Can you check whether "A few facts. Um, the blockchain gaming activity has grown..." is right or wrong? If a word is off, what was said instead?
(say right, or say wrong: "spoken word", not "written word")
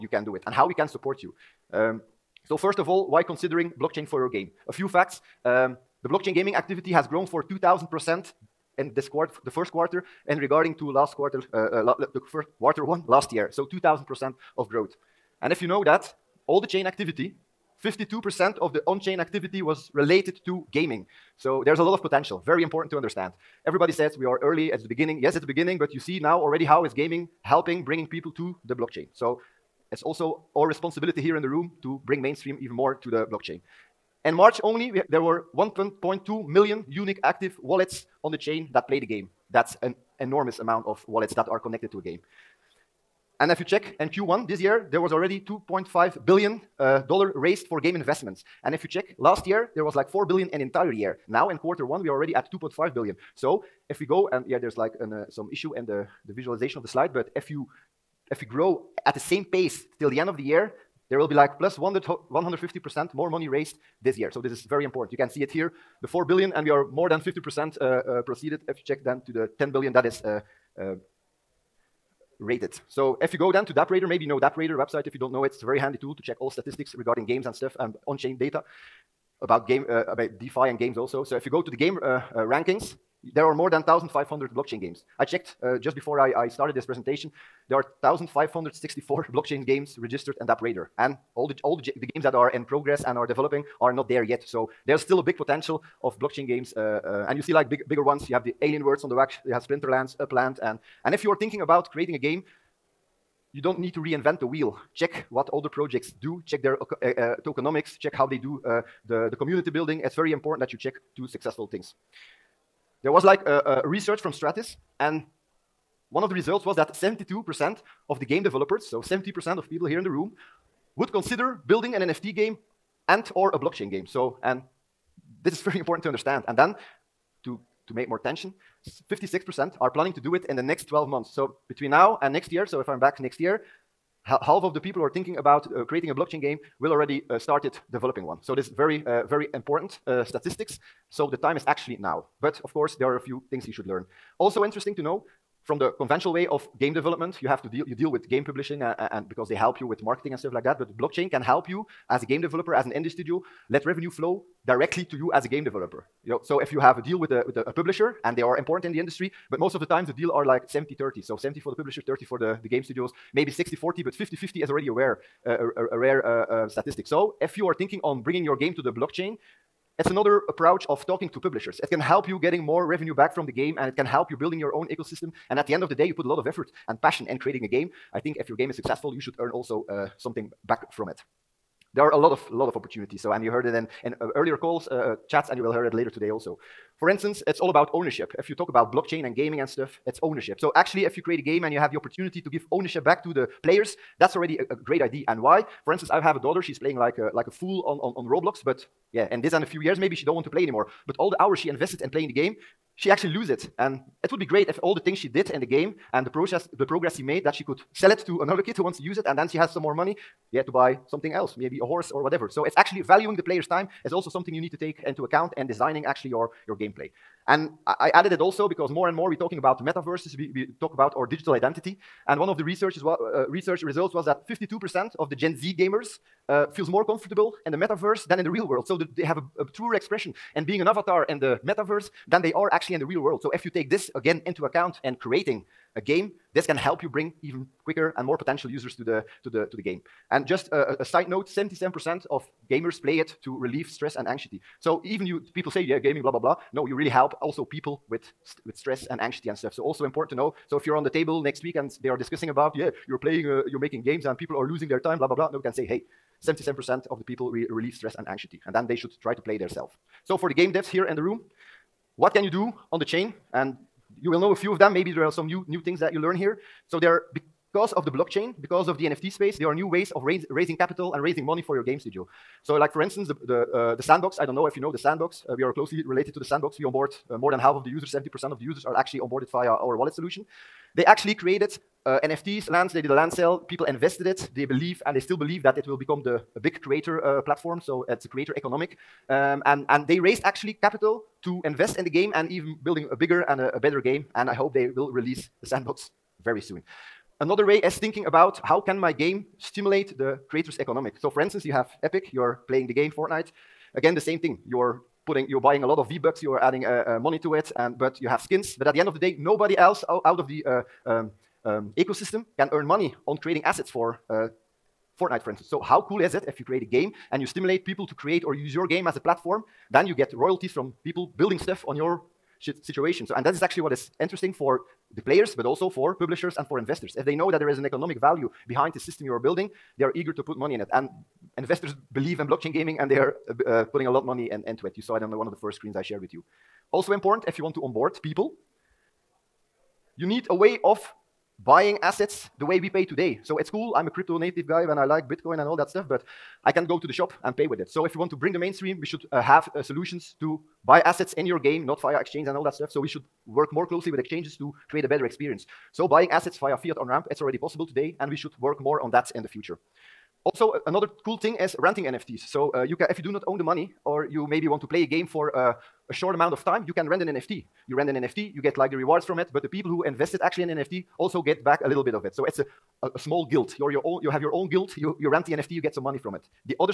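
right.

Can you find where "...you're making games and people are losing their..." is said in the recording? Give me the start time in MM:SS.
04:13.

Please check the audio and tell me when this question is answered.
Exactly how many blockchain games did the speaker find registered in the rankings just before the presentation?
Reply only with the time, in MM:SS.
01:28.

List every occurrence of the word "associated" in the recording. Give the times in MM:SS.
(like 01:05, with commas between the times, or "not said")
not said.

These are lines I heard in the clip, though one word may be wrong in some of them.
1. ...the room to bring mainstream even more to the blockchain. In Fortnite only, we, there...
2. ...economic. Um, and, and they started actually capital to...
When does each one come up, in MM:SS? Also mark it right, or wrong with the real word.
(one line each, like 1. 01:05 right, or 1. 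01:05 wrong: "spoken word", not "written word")
1. 00:31 wrong: "March", not "Fortnite"
2. 04:48 wrong: "raised", not "started".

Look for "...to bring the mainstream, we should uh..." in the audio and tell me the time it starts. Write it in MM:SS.
05:48.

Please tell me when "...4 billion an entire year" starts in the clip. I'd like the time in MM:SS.
00:50.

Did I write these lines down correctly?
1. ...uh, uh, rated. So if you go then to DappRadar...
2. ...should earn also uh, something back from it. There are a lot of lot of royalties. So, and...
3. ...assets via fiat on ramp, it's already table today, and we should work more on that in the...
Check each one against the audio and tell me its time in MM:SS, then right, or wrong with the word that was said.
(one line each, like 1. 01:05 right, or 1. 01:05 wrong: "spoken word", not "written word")
1. 01:10 right
2. 02:59 wrong: "opportunities", not "royalties"
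3. 05:56 wrong: "possible", not "table".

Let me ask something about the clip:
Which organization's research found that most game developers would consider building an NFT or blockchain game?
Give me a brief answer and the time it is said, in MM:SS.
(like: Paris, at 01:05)
Stratis, at 01:54.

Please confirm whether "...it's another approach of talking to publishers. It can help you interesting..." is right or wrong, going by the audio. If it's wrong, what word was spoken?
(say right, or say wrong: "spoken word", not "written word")
wrong: "getting", not "interesting".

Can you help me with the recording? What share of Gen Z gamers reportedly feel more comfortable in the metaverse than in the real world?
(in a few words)
52%.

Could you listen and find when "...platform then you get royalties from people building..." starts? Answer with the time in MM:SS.
05:19.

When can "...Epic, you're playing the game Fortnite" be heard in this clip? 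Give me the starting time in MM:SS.
05:02.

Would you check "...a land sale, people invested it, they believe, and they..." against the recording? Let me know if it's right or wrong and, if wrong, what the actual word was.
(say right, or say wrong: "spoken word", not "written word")
right.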